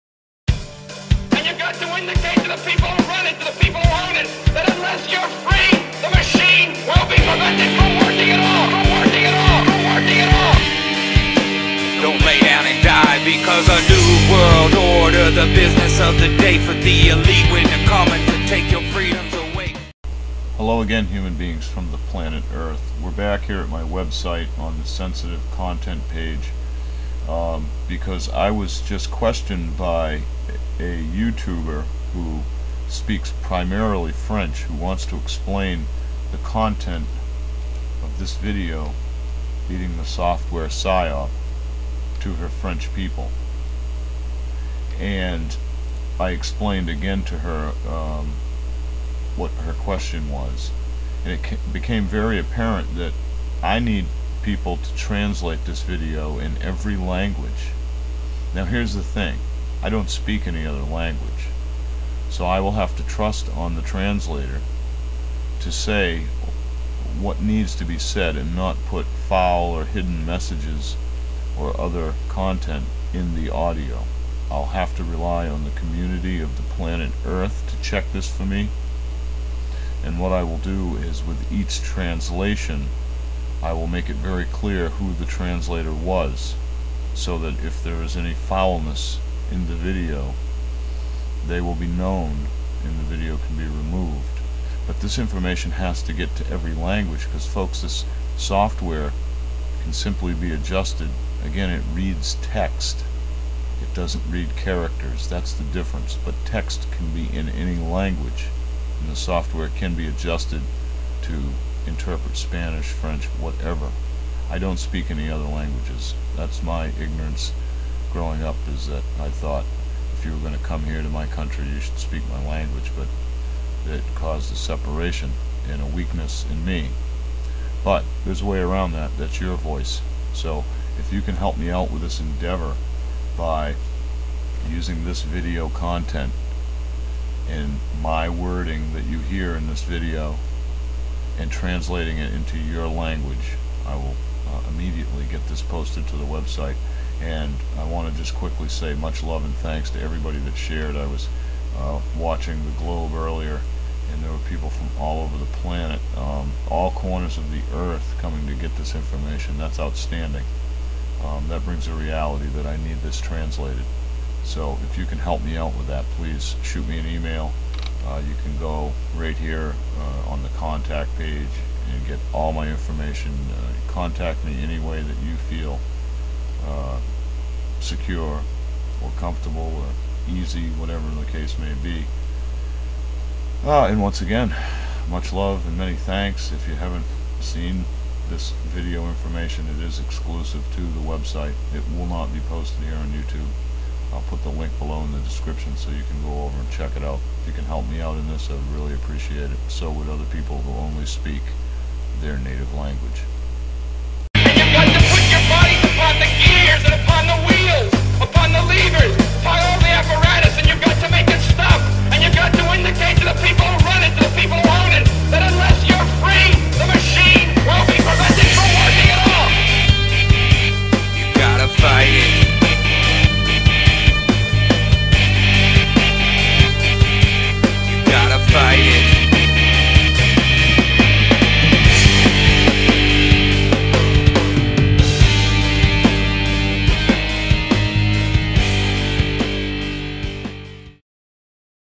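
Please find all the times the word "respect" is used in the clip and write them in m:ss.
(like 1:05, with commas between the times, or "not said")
not said.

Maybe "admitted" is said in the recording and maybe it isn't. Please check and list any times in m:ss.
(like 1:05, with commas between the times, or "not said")
not said.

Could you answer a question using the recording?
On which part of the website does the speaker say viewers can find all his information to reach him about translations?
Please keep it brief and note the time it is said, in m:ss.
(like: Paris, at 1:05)
the contact page, at 2:50.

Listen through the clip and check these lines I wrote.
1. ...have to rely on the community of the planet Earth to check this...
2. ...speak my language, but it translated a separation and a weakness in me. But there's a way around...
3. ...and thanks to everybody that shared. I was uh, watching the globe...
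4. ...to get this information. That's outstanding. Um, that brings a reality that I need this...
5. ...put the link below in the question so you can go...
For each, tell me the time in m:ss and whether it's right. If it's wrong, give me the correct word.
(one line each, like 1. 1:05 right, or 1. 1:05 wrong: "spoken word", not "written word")
1. 1:14 right
2. 2:01 wrong: "caused", not "translated"
3. 2:29 right
4. 2:38 right
5. 3:14 wrong: "description", not "question".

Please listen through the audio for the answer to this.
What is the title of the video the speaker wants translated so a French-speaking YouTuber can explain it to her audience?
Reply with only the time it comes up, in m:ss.
0:39.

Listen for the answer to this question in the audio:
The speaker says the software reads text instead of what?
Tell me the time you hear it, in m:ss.
1:44.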